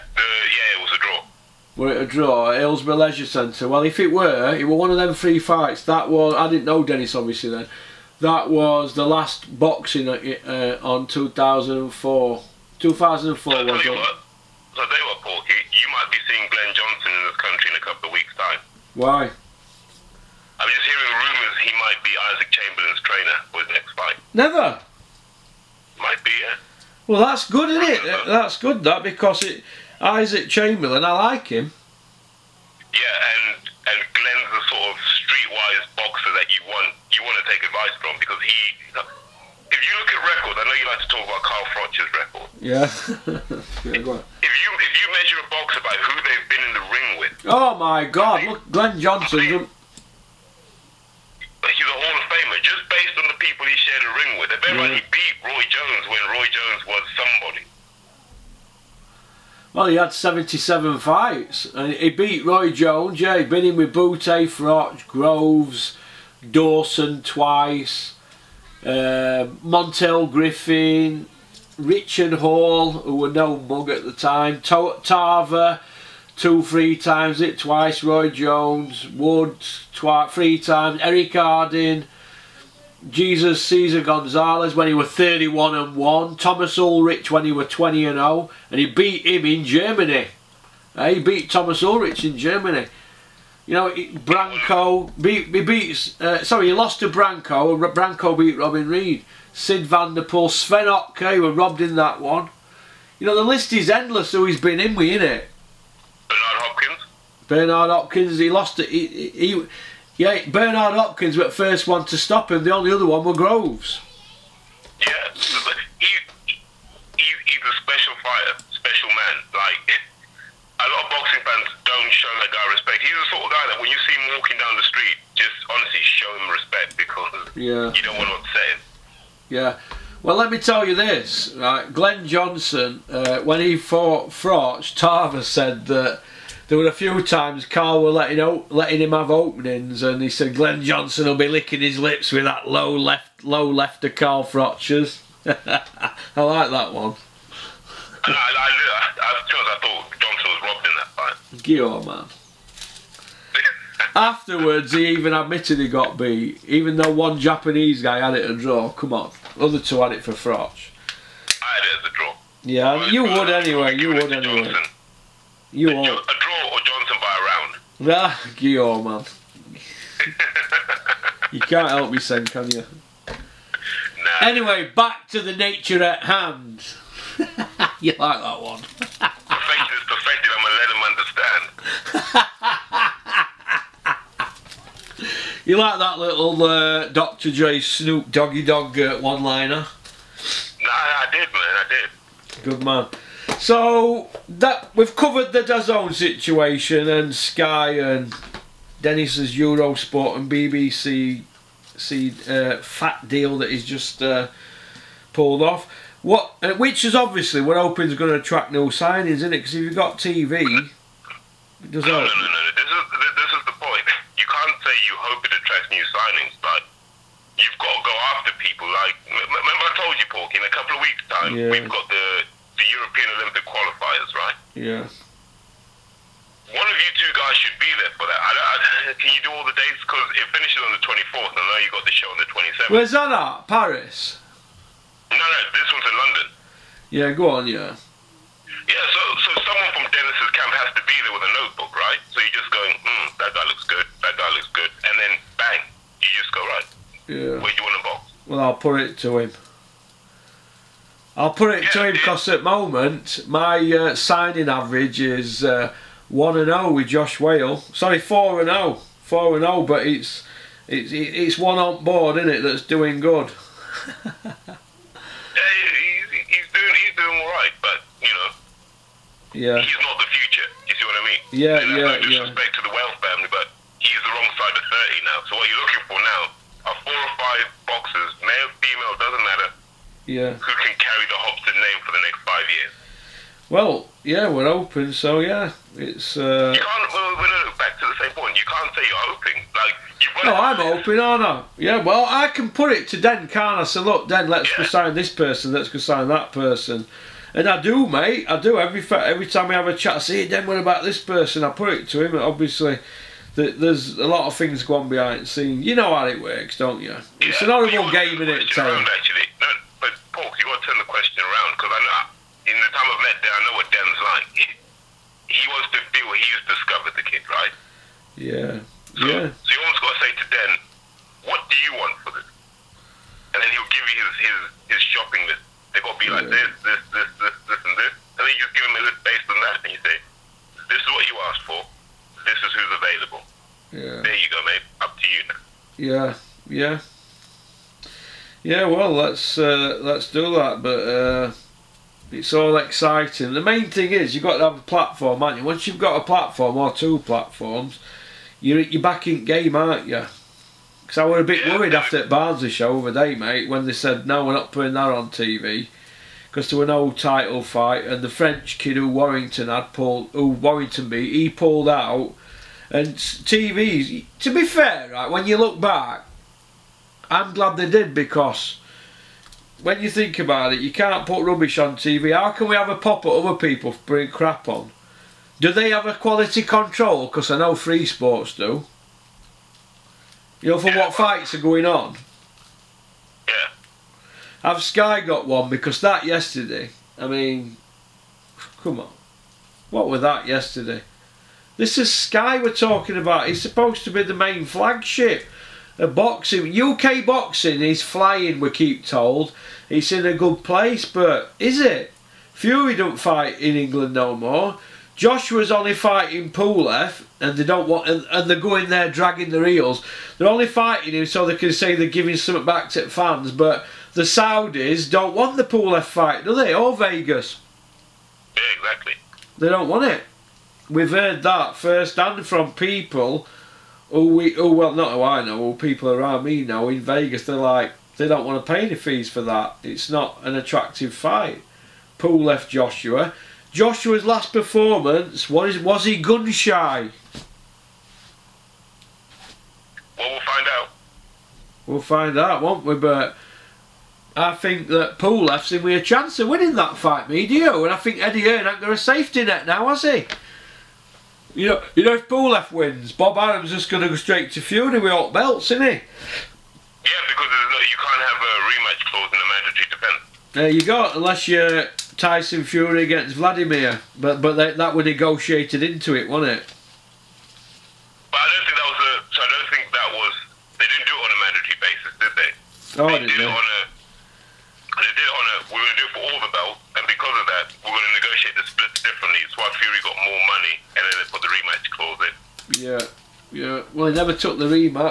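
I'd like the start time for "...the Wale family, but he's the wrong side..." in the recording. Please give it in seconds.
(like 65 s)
272 s.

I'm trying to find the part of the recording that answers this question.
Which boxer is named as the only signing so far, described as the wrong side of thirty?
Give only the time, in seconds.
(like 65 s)
257 s.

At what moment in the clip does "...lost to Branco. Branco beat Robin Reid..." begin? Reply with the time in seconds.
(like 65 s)
96 s.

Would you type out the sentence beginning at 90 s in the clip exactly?
Uh, he beat Thomas Ulrich in Germany.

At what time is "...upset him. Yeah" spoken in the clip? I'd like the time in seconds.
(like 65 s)
128 s.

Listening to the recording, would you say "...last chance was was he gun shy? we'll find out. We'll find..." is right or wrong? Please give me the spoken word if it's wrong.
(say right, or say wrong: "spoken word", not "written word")
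wrong: "performance", not "chance".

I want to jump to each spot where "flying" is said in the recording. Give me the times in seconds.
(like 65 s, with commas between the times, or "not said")
398 s.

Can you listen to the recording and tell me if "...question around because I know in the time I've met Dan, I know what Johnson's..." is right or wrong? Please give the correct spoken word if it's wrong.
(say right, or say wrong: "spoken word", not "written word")
wrong: "Dan", not "Johnson".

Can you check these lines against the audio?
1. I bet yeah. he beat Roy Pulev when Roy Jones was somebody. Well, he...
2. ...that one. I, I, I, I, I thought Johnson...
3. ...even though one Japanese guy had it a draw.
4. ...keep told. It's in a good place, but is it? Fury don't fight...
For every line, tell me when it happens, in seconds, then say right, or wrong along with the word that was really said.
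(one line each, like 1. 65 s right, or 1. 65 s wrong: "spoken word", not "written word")
1. 54 s wrong: "Jones", not "Pulev"
2. 146 s right
3. 156 s right
4. 398 s right.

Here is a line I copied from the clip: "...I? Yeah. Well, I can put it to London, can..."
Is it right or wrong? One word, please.
wrong.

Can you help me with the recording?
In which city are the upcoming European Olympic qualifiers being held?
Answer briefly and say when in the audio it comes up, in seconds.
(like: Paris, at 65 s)
London, at 236 s.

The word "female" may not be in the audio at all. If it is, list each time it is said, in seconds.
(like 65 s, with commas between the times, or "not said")
278 s.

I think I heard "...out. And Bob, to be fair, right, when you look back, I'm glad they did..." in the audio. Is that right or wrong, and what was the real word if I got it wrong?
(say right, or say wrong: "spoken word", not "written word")
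wrong: "TVs", not "Bob".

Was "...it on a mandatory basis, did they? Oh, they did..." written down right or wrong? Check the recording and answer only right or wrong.
right.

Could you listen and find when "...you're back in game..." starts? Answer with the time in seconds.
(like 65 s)
348 s.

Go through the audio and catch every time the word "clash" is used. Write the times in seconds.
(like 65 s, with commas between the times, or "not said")
not said.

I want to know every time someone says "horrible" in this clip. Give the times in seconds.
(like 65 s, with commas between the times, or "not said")
307 s.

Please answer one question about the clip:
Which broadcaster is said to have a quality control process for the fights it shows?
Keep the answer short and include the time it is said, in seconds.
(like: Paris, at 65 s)
Free Sports, at 377 s.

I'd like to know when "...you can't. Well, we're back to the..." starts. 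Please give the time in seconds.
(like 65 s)
286 s.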